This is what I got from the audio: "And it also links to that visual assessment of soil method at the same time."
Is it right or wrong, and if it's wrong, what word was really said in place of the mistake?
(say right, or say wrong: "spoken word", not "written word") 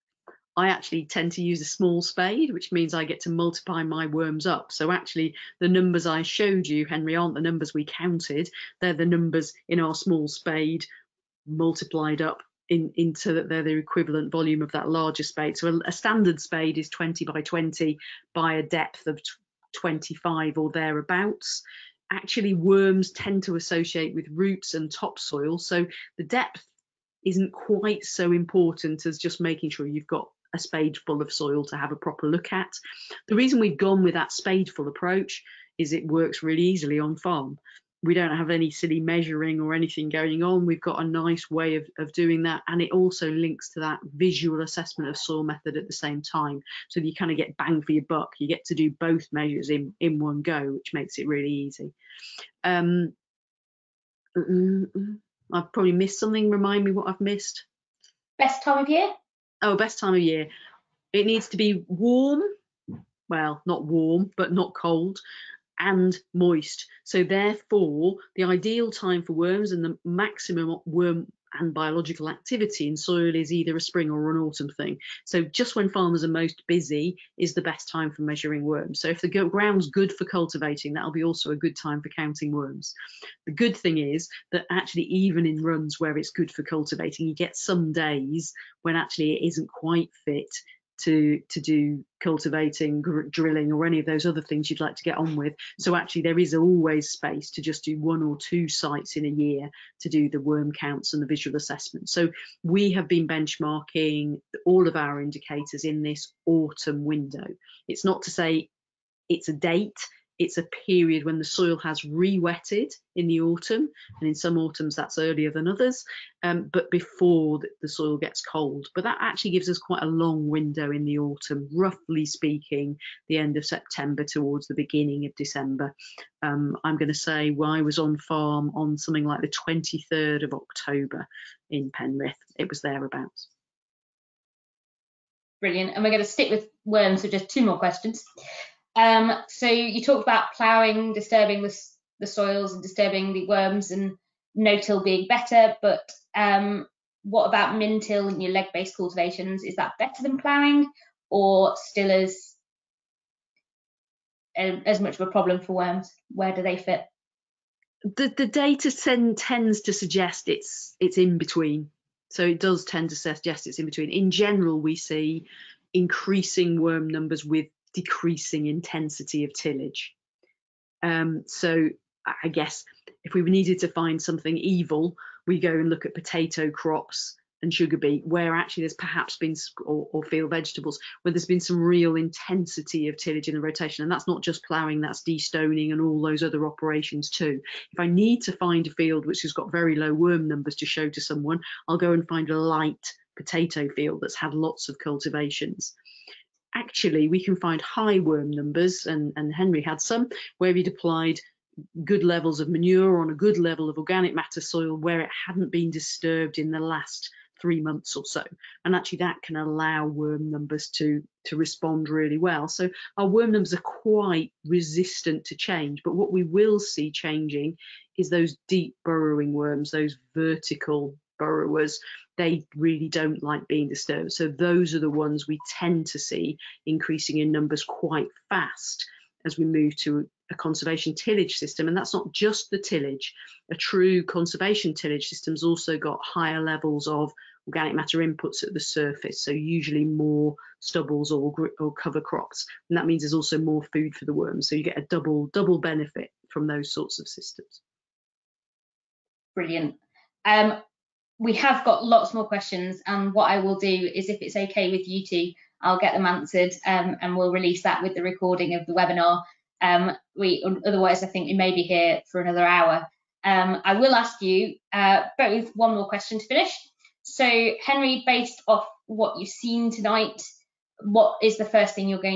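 right.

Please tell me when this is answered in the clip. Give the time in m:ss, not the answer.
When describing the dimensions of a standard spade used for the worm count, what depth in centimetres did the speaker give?
0:19.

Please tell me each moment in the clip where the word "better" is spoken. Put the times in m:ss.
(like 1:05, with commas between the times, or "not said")
2:25, 2:29.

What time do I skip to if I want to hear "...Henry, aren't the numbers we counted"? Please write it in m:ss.
0:06.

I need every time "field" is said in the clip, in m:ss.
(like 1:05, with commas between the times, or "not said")
3:00, 3:08, 3:13.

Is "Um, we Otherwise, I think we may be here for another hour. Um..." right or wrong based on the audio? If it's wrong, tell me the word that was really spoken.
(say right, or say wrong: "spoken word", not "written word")
right.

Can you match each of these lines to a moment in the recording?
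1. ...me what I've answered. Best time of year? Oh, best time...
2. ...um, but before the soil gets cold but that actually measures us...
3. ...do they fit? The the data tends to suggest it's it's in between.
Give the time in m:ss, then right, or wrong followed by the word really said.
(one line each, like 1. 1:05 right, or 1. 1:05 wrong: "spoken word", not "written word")
1. 0:56 wrong: "missed", not "answered"
2. 1:56 wrong: "gives", not "measures"
3. 2:36 right.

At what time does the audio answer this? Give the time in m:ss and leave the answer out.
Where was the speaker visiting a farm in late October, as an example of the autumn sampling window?
2:11.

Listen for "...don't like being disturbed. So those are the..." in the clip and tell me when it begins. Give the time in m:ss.
3:43.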